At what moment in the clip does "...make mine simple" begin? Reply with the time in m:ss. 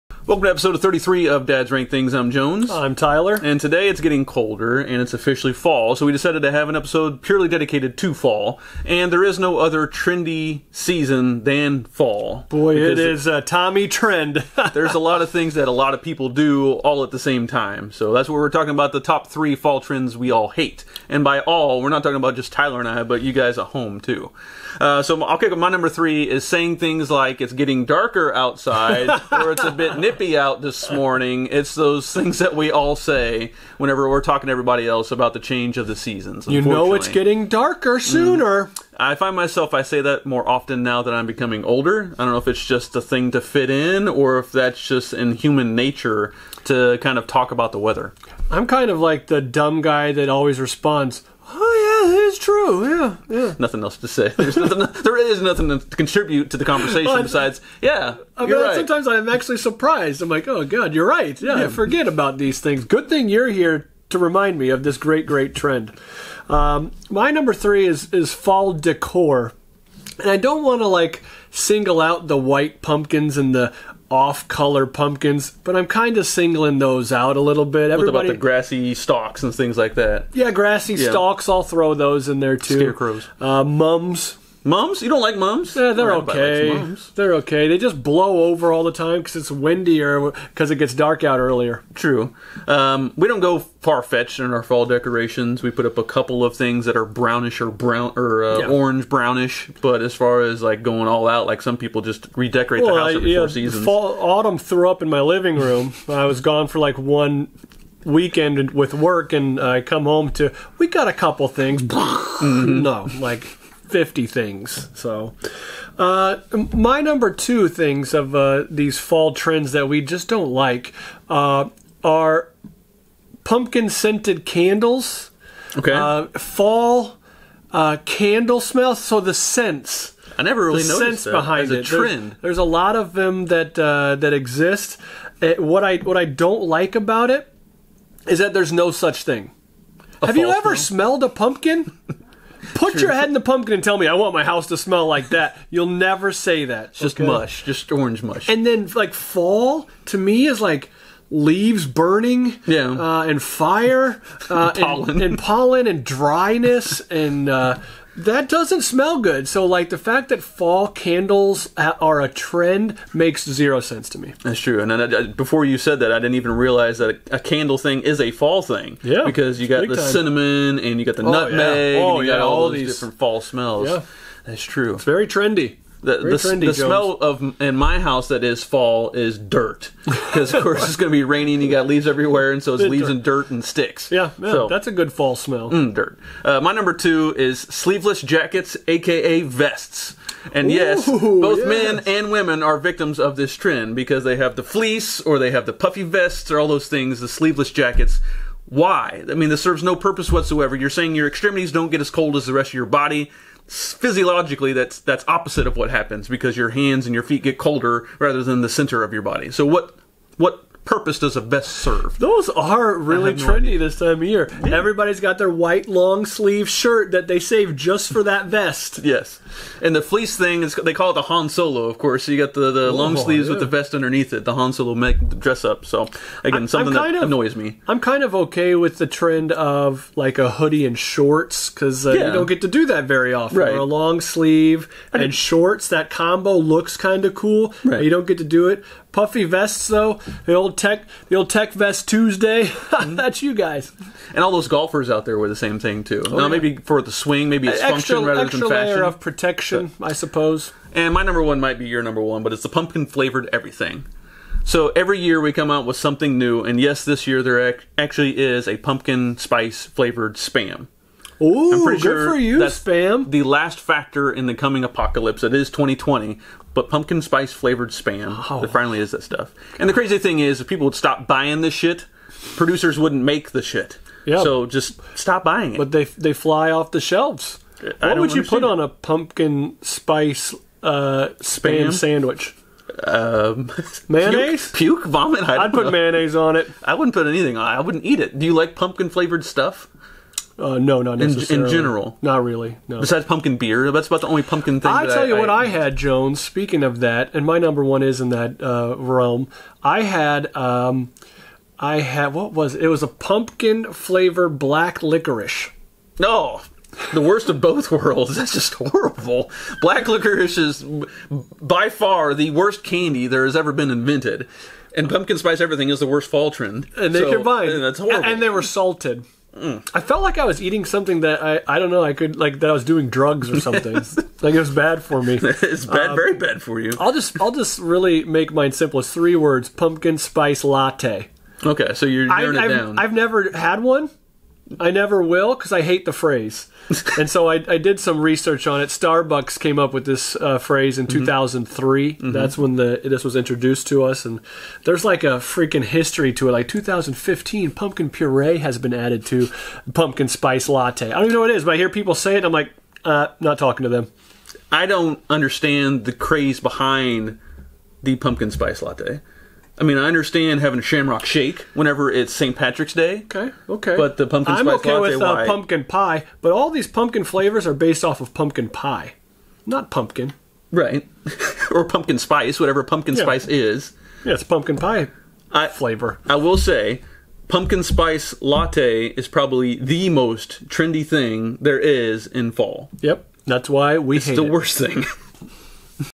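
5:28.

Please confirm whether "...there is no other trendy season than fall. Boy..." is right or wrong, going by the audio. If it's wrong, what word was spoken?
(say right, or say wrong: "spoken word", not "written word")
right.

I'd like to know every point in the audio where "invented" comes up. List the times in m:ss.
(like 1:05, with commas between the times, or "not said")
5:13.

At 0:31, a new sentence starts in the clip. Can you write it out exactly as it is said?
It's those things that we all say whenever we're talking to everybody else about the change of the seasons.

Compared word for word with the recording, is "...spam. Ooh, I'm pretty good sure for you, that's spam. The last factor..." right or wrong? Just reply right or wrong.
right.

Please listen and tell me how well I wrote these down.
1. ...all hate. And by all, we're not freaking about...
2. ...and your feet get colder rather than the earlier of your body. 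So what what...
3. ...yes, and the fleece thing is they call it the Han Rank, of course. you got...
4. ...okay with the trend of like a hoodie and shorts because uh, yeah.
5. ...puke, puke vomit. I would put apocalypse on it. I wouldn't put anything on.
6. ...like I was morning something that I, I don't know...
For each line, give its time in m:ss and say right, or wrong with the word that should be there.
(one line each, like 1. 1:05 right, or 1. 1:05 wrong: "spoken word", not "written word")
1. 0:20 wrong: "talking", not "freaking"
2. 3:27 wrong: "center", not "earlier"
3. 3:39 wrong: "Solo", not "Rank"
4. 3:48 right
5. 4:44 wrong: "mayonnaise", not "apocalypse"
6. 5:20 wrong: "eating", not "morning".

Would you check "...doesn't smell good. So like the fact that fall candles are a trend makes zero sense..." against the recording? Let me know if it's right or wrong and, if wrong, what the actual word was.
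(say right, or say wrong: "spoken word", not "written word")
right.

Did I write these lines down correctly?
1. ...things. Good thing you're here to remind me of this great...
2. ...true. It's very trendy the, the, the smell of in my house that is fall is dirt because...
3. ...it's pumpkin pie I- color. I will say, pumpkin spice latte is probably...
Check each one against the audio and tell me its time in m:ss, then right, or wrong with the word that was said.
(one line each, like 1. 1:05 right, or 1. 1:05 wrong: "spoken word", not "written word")
1. 1:02 right
2. 2:54 right
3. 6:14 wrong: "flavor", not "color".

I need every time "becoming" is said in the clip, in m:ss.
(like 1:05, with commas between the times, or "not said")
0:41.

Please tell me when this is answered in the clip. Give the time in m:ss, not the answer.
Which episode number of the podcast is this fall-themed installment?
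0:00.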